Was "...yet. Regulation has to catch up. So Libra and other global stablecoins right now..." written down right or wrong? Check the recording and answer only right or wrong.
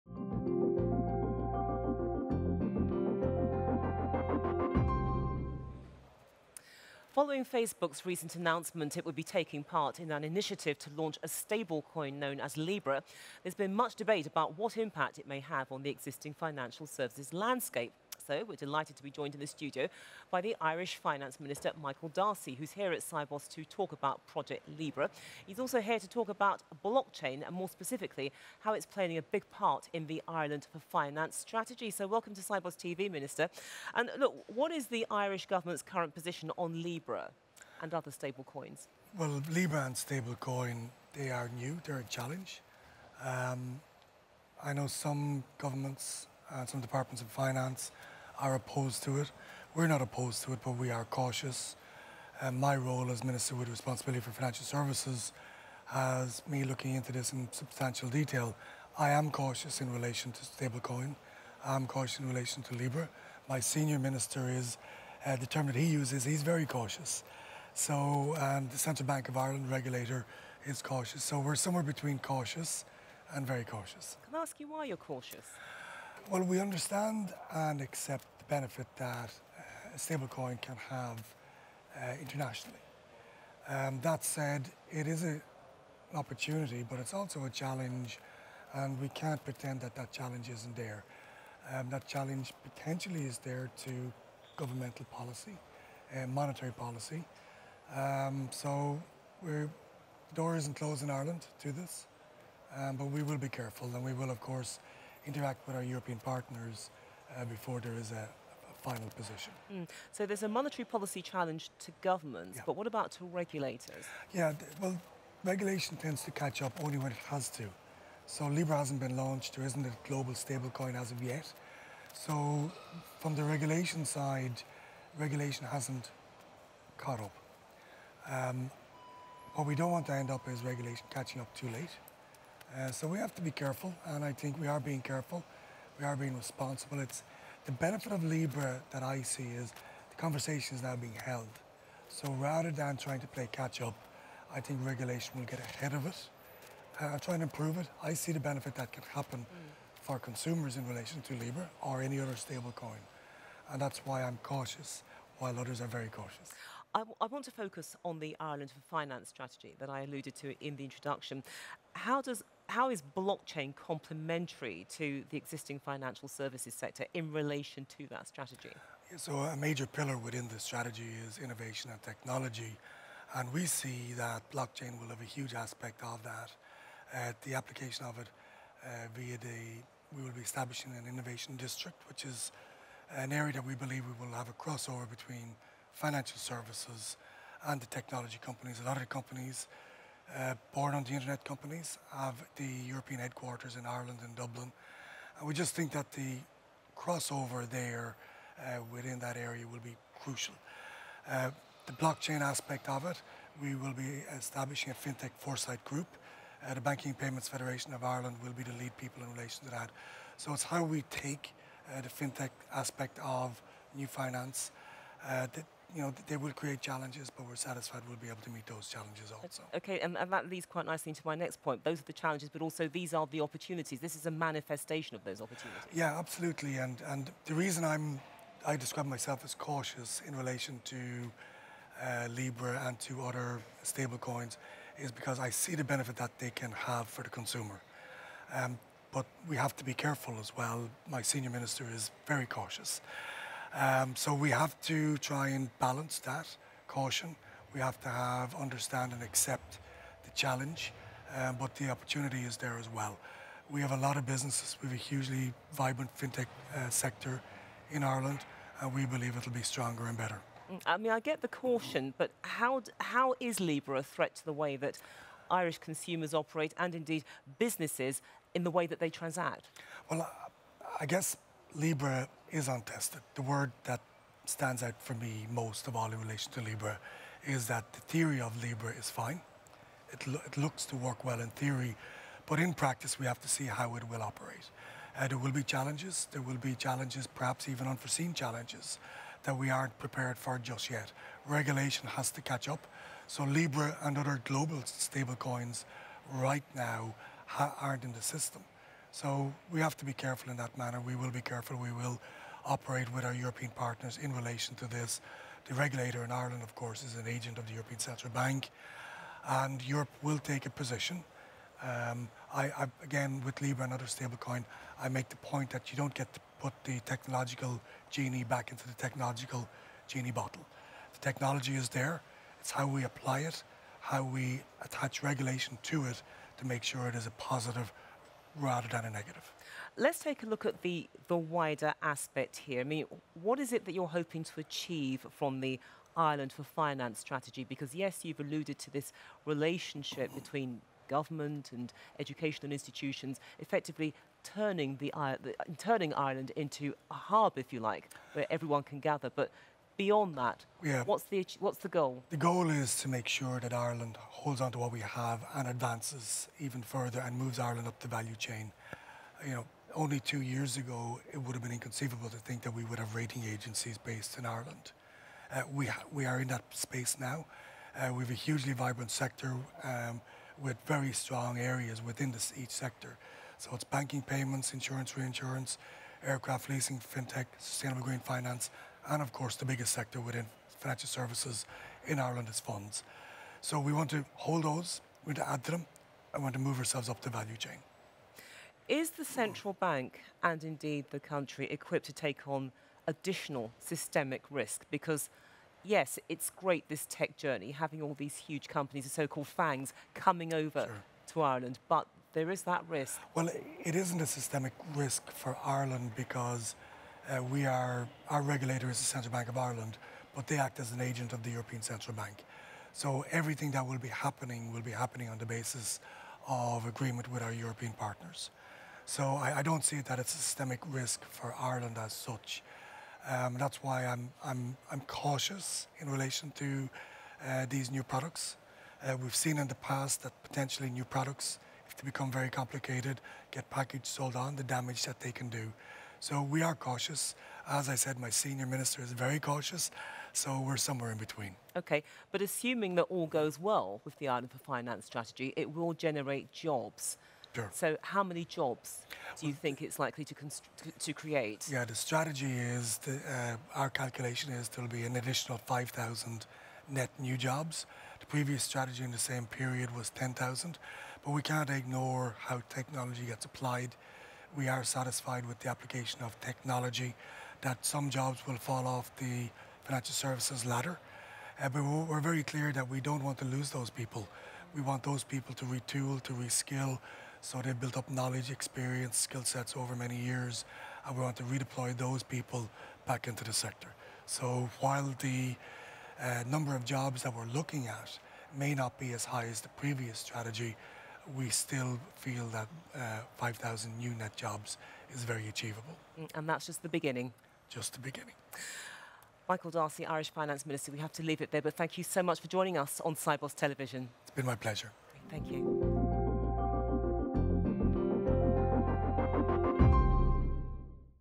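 right.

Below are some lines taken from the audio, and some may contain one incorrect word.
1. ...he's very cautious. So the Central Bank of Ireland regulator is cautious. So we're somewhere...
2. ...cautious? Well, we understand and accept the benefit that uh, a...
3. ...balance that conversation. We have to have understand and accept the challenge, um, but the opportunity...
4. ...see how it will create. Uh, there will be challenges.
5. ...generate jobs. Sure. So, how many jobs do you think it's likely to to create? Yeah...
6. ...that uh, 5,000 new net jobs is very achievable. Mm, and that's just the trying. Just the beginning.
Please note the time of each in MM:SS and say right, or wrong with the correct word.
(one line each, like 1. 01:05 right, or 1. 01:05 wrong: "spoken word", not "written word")
1. 01:06 right
2. 01:14 right
3. 04:05 wrong: "caution", not "conversation"
4. 04:43 wrong: "operate", not "create"
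5. 07:25 right
6. 08:12 wrong: "beginning", not "trying".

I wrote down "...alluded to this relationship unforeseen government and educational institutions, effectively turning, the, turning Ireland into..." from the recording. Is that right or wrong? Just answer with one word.
wrong.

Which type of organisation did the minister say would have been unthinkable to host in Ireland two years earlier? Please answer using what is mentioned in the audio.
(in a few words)
rating agencies.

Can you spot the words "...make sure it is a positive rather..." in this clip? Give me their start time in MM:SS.
05:26.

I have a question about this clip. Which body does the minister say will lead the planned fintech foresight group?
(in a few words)
Banking Payments Federation of Ireland.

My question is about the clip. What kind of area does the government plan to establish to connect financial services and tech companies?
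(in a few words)
innovation district.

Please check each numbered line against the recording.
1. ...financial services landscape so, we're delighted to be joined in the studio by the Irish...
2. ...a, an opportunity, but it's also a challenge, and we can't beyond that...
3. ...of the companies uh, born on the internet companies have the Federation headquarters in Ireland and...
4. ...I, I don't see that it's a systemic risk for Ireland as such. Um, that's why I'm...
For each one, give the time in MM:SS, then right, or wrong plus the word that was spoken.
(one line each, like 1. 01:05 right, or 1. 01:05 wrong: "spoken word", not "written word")
1. 00:16 right
2. 01:25 wrong: "pretend", not "beyond"
3. 03:08 wrong: "European", not "Federation"
4. 06:59 right.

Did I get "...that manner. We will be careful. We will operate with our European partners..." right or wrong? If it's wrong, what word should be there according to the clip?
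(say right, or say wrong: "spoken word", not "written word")
right.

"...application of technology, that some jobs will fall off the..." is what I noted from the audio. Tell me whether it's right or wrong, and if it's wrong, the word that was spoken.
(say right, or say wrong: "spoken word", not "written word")
right.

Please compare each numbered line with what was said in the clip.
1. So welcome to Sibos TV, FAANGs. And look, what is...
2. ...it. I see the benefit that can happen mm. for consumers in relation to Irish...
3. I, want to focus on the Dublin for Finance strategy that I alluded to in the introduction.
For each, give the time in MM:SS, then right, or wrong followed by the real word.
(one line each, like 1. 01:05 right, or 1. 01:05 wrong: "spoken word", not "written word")
1. 00:31 wrong: "Minister", not "FAANGs"
2. 02:27 wrong: "Libra", not "Irish"
3. 02:36 wrong: "Ireland", not "Dublin".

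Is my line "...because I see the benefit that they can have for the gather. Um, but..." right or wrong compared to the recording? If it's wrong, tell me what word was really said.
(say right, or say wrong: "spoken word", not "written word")
wrong: "consumer", not "gather".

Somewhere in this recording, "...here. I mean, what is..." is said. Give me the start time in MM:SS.
05:32.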